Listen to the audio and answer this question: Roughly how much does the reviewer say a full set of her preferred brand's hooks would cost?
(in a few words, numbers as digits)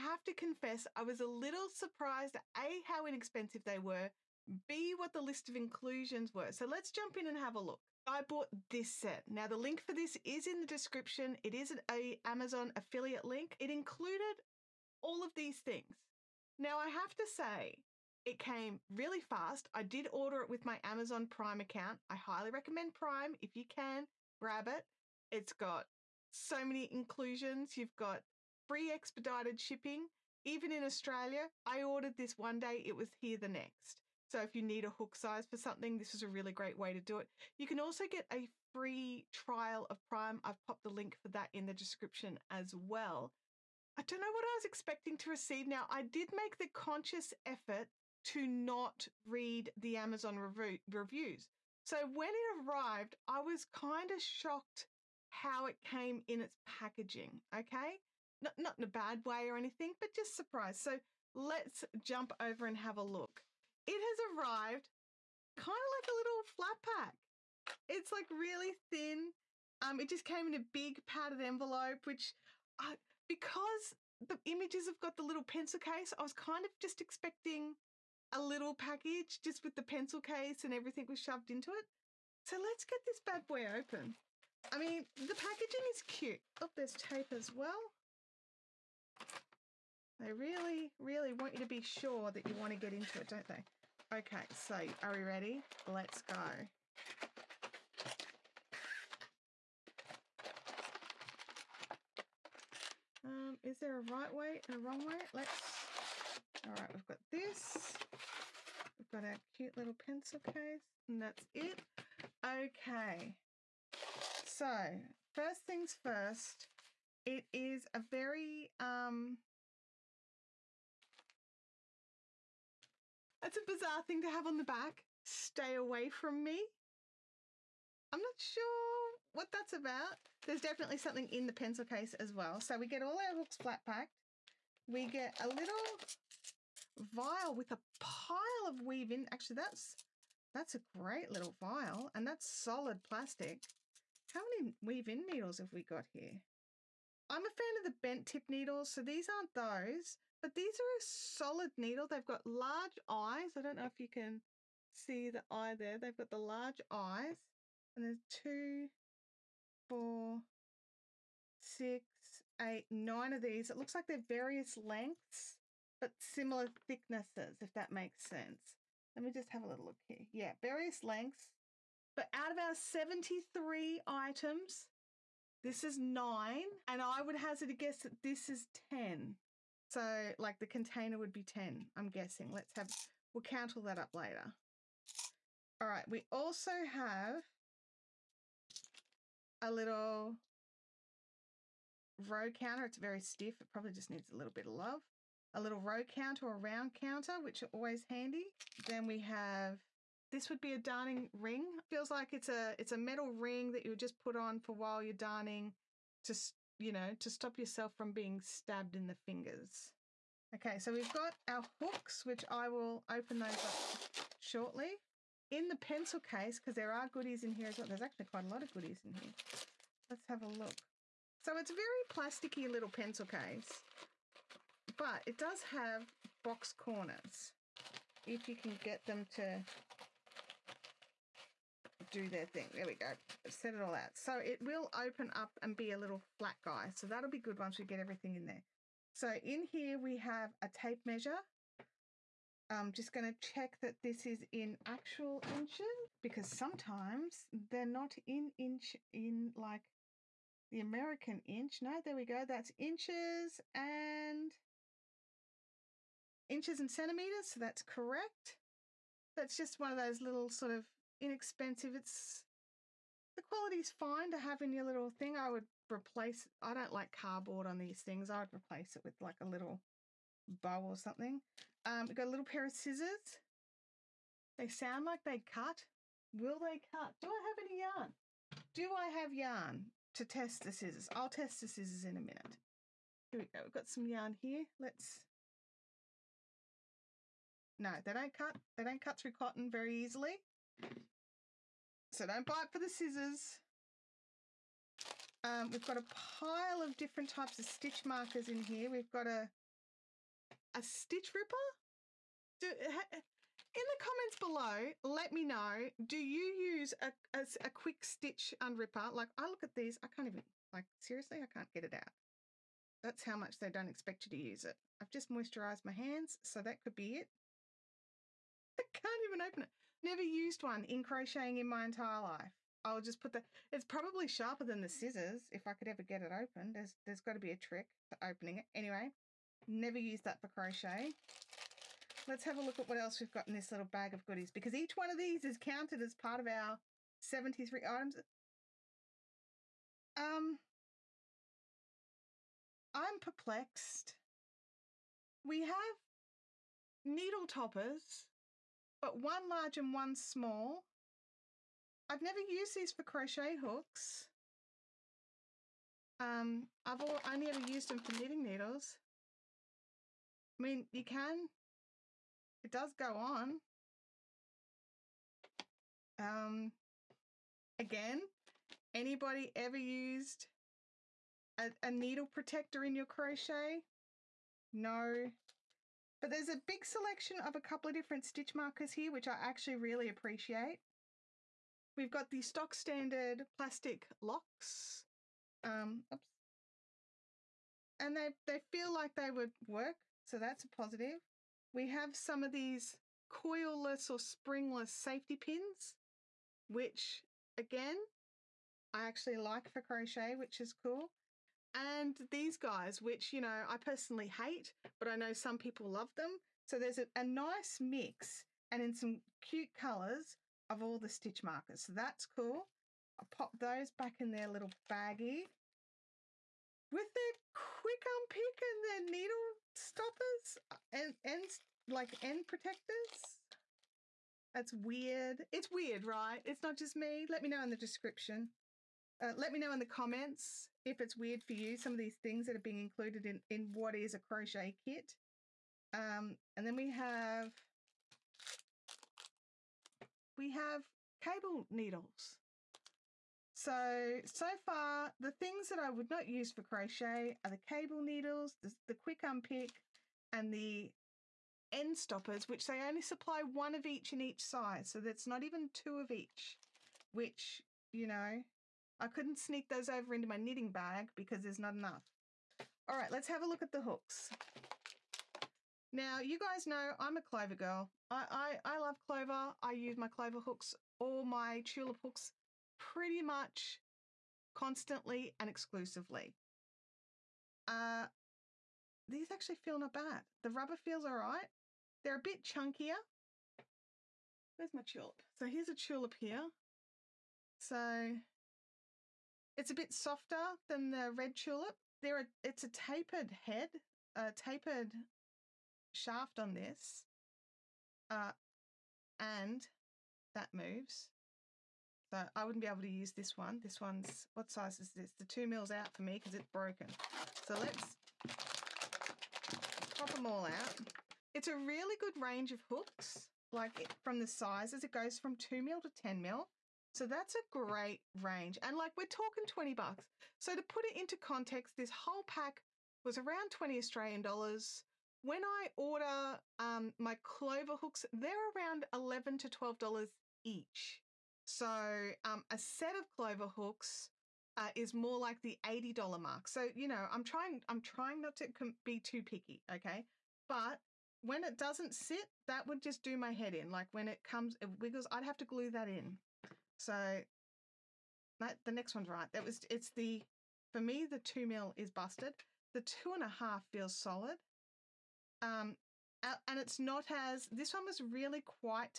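$80.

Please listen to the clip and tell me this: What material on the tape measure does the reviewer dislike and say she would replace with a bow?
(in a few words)
cardboard.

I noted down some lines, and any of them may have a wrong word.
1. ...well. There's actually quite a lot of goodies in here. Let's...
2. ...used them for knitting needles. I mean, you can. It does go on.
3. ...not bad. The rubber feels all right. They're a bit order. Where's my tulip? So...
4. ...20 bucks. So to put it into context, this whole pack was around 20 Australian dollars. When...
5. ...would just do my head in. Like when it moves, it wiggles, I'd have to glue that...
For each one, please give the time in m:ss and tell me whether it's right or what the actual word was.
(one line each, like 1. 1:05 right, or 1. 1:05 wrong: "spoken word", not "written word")
1. 3:37 right
2. 5:57 right
3. 7:59 wrong: "chunkier", not "order"
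4. 8:39 right
5. 9:02 wrong: "comes", not "moves".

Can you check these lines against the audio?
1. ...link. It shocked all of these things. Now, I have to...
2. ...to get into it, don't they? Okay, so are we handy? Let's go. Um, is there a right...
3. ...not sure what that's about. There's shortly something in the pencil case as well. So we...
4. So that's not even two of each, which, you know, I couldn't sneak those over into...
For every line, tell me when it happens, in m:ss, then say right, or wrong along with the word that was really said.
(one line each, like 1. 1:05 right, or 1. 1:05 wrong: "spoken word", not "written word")
1. 0:13 wrong: "included", not "shocked"
2. 1:32 wrong: "ready", not "handy"
3. 2:08 wrong: "definitely", not "shortly"
4. 7:34 right.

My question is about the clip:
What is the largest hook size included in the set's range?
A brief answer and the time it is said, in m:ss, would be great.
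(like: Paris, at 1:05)
10 mm, at 8:35.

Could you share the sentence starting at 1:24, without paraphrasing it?
I mean, the packaging is cute.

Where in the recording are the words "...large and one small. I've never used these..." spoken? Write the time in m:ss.
5:49.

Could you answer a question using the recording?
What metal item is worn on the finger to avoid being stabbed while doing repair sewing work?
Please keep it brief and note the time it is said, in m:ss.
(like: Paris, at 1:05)
darning ring, at 3:20.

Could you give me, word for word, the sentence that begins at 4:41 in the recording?
I'll test the scissors in a minute.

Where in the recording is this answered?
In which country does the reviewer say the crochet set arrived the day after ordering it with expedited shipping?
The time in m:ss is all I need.
0:30.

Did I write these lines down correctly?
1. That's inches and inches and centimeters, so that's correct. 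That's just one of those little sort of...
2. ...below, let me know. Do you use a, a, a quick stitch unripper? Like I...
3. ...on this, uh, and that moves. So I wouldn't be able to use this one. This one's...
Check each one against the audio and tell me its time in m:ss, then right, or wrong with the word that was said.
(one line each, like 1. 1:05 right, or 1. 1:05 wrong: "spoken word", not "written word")
1. 4:12 right
2. 5:04 right
3. 8:16 right.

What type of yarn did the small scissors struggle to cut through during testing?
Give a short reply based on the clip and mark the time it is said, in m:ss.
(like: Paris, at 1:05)
cotton, at 4:49.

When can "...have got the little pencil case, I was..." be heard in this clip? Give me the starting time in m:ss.
1:14.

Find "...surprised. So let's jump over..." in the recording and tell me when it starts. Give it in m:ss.
1:00.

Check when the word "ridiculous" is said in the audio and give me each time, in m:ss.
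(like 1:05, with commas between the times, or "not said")
not said.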